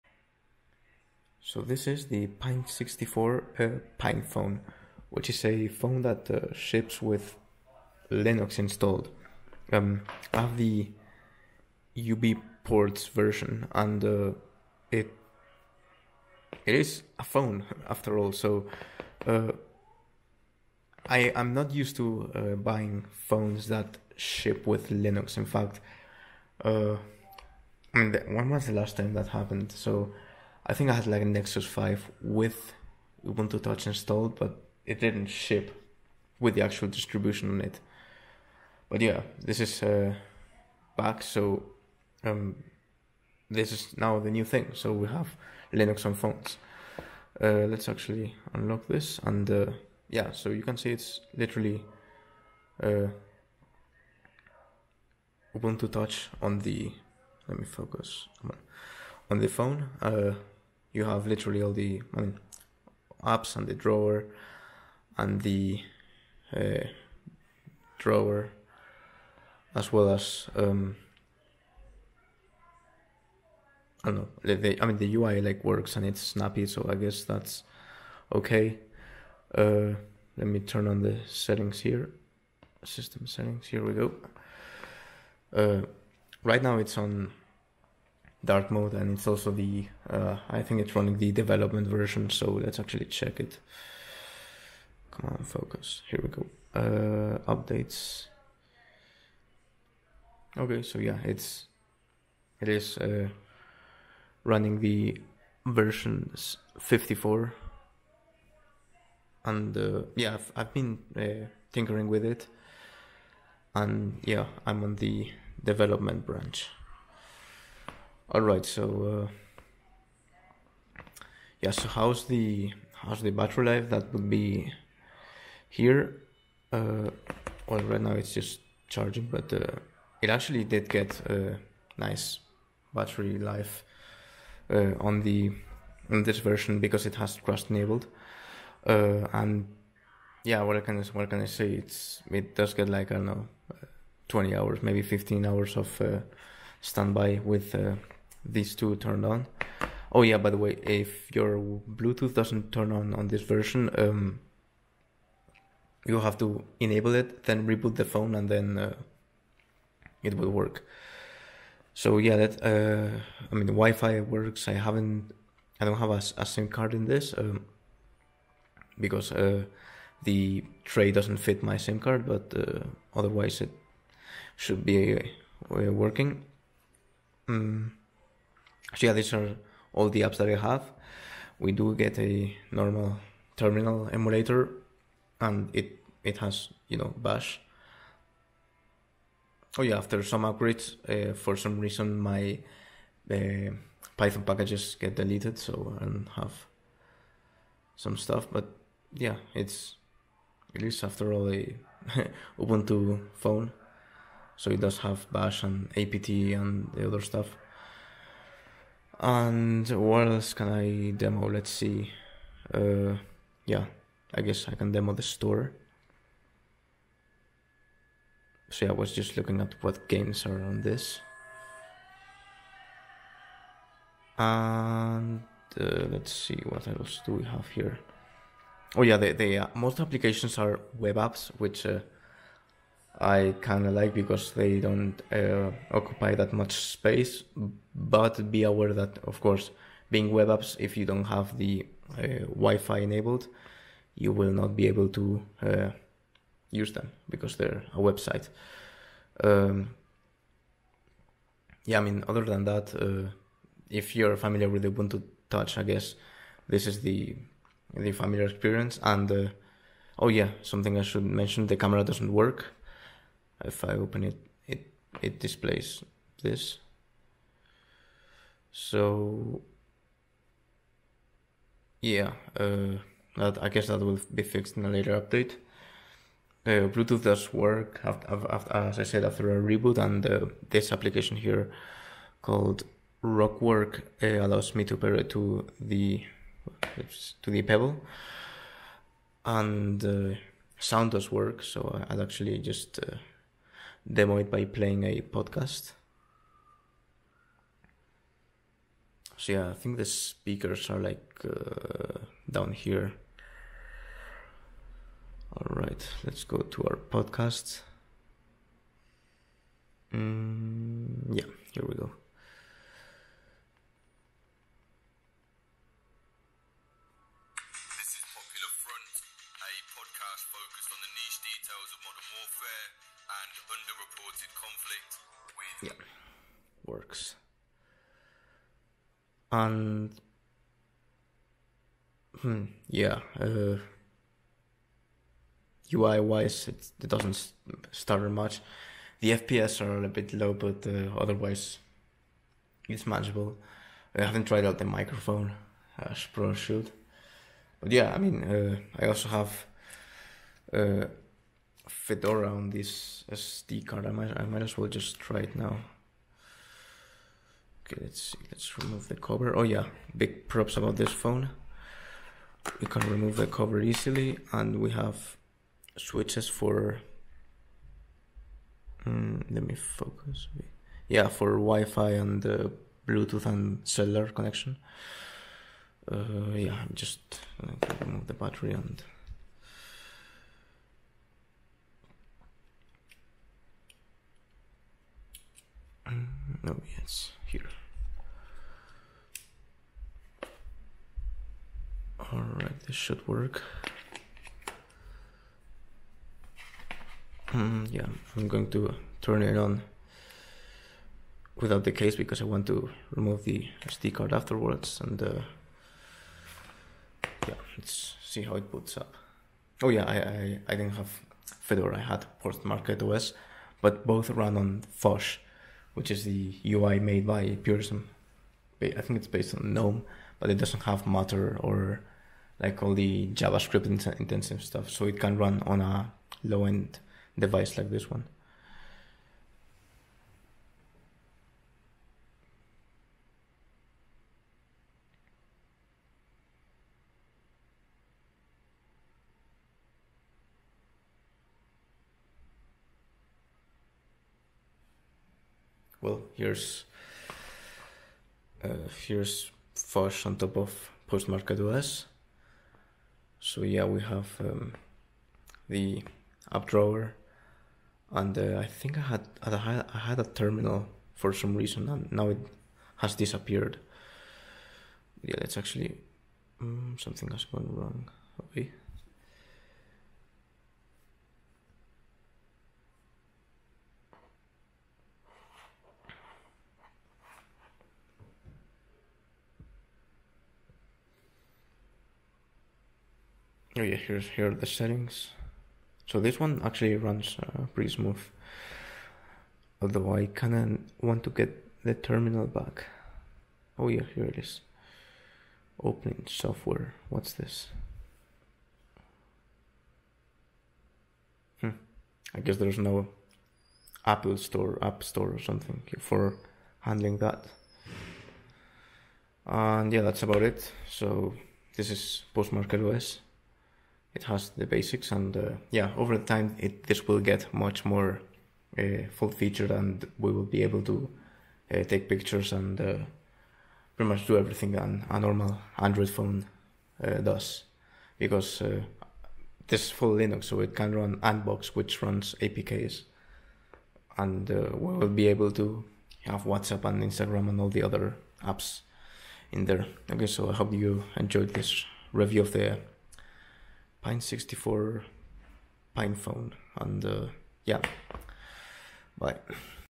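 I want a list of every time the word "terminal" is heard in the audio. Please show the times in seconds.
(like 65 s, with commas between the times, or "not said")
183 s, 460 s, 491 s.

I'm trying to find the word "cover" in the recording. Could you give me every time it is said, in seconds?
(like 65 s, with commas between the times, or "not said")
359 s, 363 s.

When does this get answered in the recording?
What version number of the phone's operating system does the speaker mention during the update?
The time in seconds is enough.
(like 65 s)
106 s.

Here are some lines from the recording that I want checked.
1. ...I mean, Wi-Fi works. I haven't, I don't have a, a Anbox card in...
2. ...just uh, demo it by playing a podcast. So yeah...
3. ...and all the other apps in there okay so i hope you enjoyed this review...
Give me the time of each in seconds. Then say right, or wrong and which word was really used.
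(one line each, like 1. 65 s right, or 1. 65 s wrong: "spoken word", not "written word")
1. 163 s wrong: "SIM", not "Anbox"
2. 292 s right
3. 537 s right.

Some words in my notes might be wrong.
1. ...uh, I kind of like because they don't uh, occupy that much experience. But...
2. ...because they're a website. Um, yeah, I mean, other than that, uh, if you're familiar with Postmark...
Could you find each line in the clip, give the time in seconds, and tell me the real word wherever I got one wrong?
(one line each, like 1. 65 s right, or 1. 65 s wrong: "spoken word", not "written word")
1. 231 s wrong: "space", not "experience"
2. 247 s wrong: "Ubuntu", not "Postmark".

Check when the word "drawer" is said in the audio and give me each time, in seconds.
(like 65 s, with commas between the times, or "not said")
63 s, 67 s, 456 s.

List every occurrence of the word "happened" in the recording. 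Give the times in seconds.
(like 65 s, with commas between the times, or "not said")
29 s.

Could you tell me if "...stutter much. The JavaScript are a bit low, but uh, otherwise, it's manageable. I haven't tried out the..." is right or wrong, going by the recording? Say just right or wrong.
wrong.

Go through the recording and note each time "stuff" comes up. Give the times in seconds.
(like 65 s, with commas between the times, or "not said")
198 s, 207 s, 424 s.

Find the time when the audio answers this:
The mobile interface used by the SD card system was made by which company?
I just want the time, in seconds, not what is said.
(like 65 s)
417 s.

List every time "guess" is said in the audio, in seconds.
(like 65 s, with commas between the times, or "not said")
76 s, 214 s, 255 s, 273 s, 502 s.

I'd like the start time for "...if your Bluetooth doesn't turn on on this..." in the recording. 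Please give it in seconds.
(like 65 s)
150 s.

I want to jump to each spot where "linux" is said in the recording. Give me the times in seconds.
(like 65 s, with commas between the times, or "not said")
8 s, 24 s, 45 s, 530 s.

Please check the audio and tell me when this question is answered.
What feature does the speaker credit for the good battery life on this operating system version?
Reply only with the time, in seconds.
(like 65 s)
137 s.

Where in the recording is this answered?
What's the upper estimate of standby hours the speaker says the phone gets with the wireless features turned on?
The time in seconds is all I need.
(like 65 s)
144 s.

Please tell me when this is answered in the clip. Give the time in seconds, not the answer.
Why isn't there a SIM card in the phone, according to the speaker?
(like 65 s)
170 s.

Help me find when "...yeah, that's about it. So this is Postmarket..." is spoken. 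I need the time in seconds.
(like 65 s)
509 s.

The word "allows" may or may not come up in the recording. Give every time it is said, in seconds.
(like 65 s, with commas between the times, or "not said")
284 s.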